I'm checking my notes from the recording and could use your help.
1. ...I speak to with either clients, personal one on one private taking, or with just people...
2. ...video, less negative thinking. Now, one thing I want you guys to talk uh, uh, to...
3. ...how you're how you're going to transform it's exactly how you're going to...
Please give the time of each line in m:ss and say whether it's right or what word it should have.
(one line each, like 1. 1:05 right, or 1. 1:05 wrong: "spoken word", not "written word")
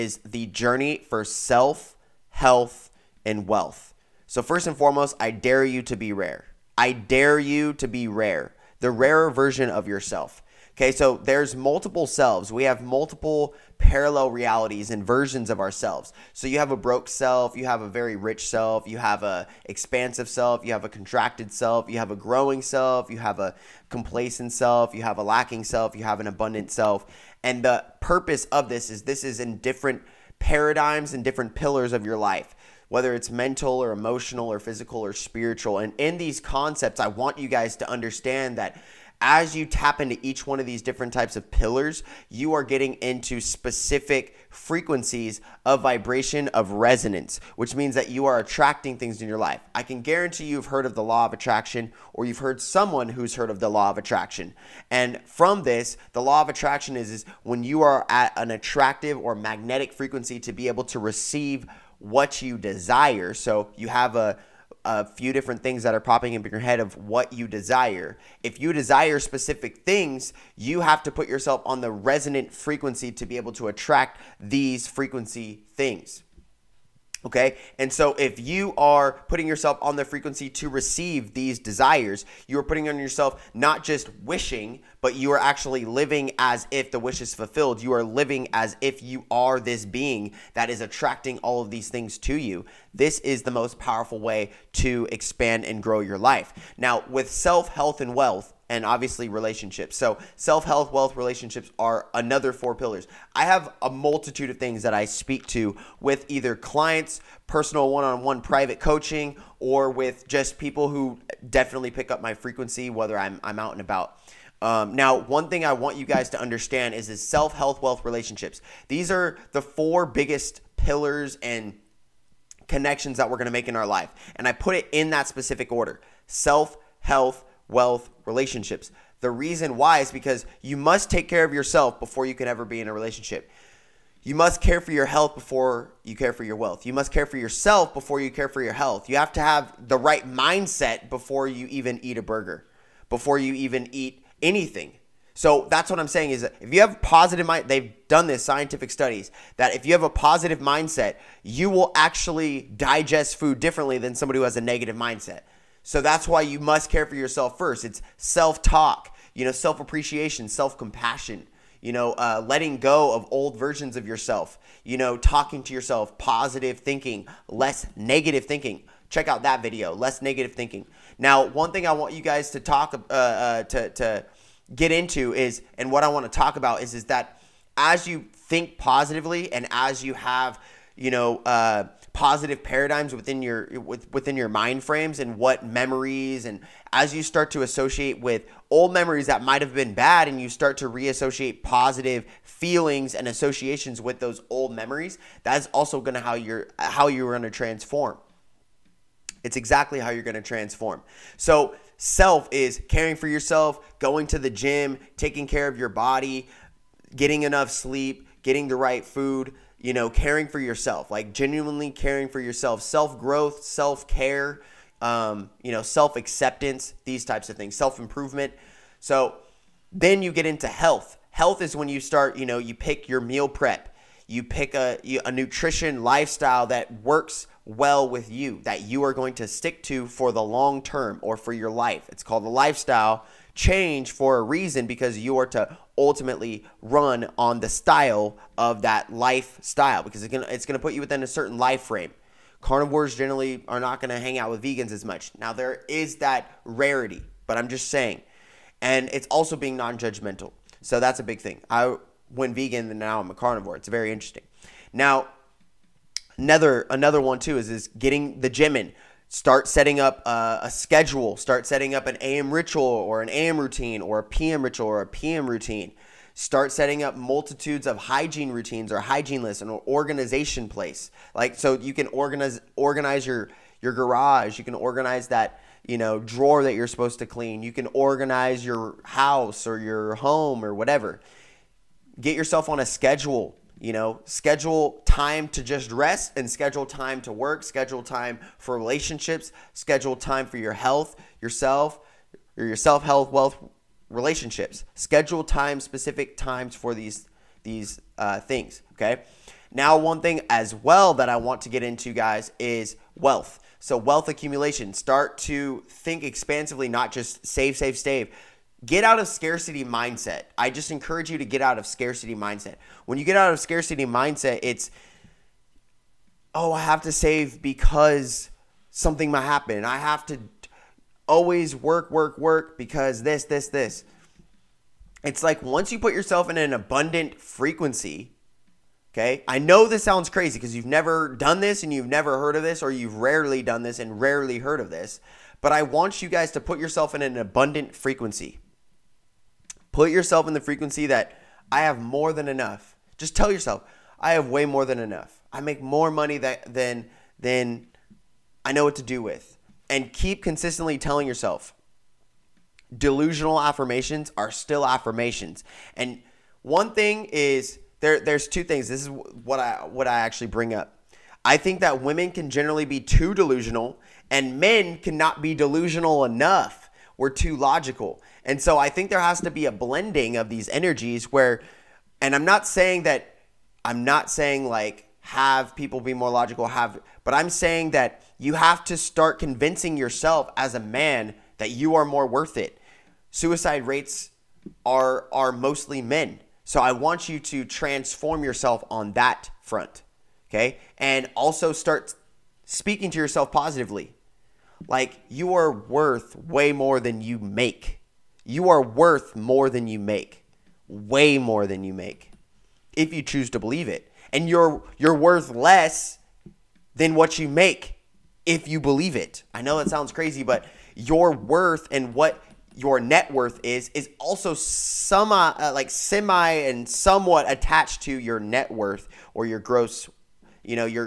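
1. 1:44 wrong: "coaching", not "taking"
2. 2:49 right
3. 3:16 right.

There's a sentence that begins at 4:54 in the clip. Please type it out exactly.
Schedule time, specific times for these these uh, things.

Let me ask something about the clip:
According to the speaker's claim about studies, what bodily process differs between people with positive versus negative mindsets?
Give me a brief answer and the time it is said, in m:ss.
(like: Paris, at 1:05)
digest food, at 2:32.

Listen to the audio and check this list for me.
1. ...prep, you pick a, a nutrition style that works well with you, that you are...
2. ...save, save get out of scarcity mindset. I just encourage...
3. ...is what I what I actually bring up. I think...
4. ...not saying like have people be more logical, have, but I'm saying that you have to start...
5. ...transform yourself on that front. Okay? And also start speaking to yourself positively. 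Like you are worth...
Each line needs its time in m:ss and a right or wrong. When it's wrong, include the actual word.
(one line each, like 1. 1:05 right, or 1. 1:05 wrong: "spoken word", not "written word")
1. 3:43 wrong: "lifestyle", not "style"
2. 5:07 right
3. 5:59 right
4. 6:14 right
5. 6:27 right.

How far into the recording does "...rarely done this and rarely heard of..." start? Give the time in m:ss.
5:33.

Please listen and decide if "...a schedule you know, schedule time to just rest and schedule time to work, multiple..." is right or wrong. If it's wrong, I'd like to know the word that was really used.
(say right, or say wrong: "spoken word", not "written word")
wrong: "schedule", not "multiple".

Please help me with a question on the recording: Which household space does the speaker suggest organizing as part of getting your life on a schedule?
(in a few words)
garage.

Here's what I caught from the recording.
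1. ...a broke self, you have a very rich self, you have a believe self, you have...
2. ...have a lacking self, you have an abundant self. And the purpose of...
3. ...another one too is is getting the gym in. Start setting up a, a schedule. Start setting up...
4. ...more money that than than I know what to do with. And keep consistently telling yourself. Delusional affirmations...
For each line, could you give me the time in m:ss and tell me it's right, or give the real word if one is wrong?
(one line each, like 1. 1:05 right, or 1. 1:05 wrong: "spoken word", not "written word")
1. 0:16 wrong: "expansive", not "believe"
2. 0:25 right
3. 4:16 right
4. 5:45 right.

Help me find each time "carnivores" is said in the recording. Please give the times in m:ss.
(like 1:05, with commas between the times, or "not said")
4:02, 4:13.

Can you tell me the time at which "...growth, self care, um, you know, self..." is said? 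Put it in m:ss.
3:33.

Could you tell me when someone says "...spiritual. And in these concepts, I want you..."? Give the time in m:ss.
0:35.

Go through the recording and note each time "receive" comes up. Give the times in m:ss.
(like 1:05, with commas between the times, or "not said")
1:00, 1:20.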